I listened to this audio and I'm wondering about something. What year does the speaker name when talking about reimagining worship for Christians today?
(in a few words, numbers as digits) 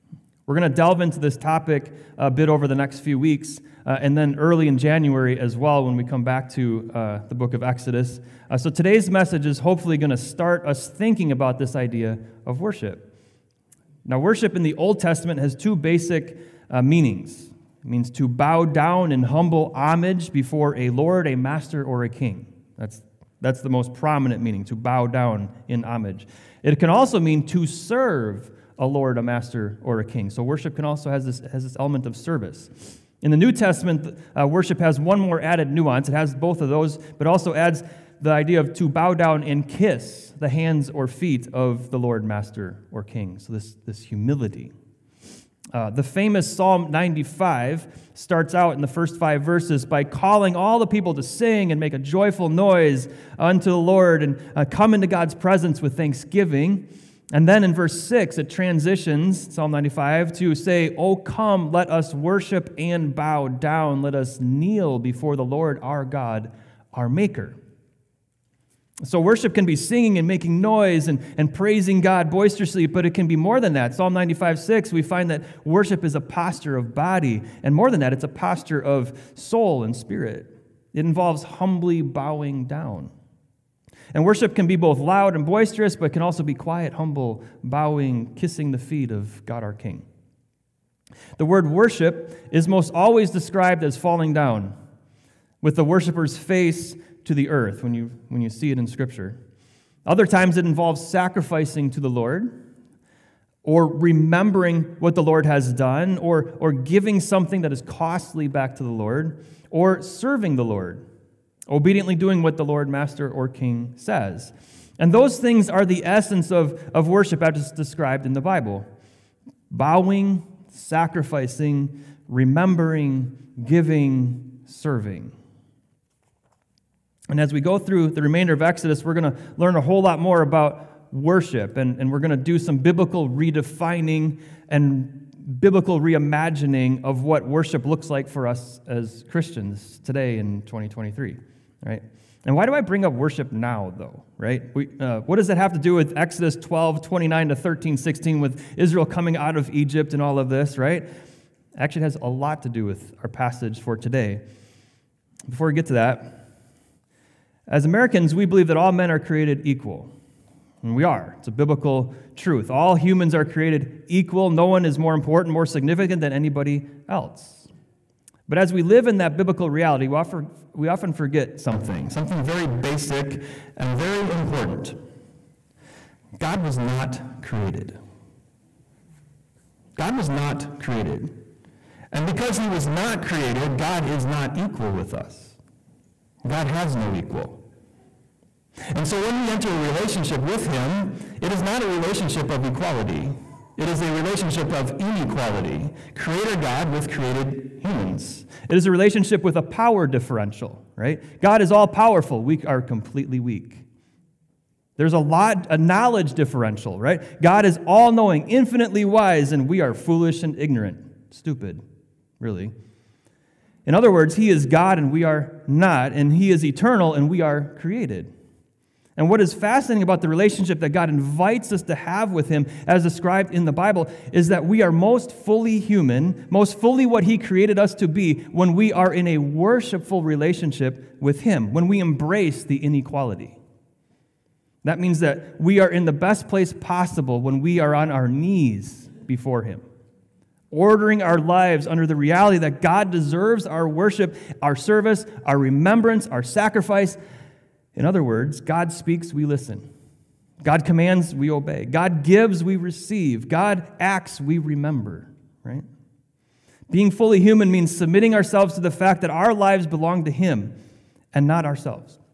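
2023.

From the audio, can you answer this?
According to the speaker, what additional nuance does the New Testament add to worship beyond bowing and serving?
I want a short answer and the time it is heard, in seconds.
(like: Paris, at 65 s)
Kiss the hands or feet, at 39 s.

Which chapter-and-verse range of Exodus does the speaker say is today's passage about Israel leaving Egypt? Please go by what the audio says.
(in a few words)
Exodus 12:29 to 13:16.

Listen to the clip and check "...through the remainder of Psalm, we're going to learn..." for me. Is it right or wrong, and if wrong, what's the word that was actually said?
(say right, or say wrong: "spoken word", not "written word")
wrong: "Exodus", not "Psalm".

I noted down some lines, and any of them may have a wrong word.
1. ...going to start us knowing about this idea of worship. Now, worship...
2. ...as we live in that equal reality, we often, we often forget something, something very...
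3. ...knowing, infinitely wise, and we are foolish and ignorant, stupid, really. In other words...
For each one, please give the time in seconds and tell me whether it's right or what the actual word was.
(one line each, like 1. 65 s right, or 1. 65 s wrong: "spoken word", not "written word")
1. 9 s wrong: "thinking", not "knowing"
2. 168 s wrong: "biblical", not "equal"
3. 208 s right.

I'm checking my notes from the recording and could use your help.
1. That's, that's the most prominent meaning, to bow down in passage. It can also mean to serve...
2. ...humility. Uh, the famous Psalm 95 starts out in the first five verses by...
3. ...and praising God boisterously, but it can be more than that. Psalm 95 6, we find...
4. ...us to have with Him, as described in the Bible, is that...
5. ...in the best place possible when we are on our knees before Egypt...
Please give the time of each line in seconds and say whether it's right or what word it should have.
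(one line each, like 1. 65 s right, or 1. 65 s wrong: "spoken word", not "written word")
1. 22 s wrong: "homage", not "passage"
2. 44 s right
3. 71 s right
4. 221 s right
5. 235 s wrong: "Him", not "Egypt".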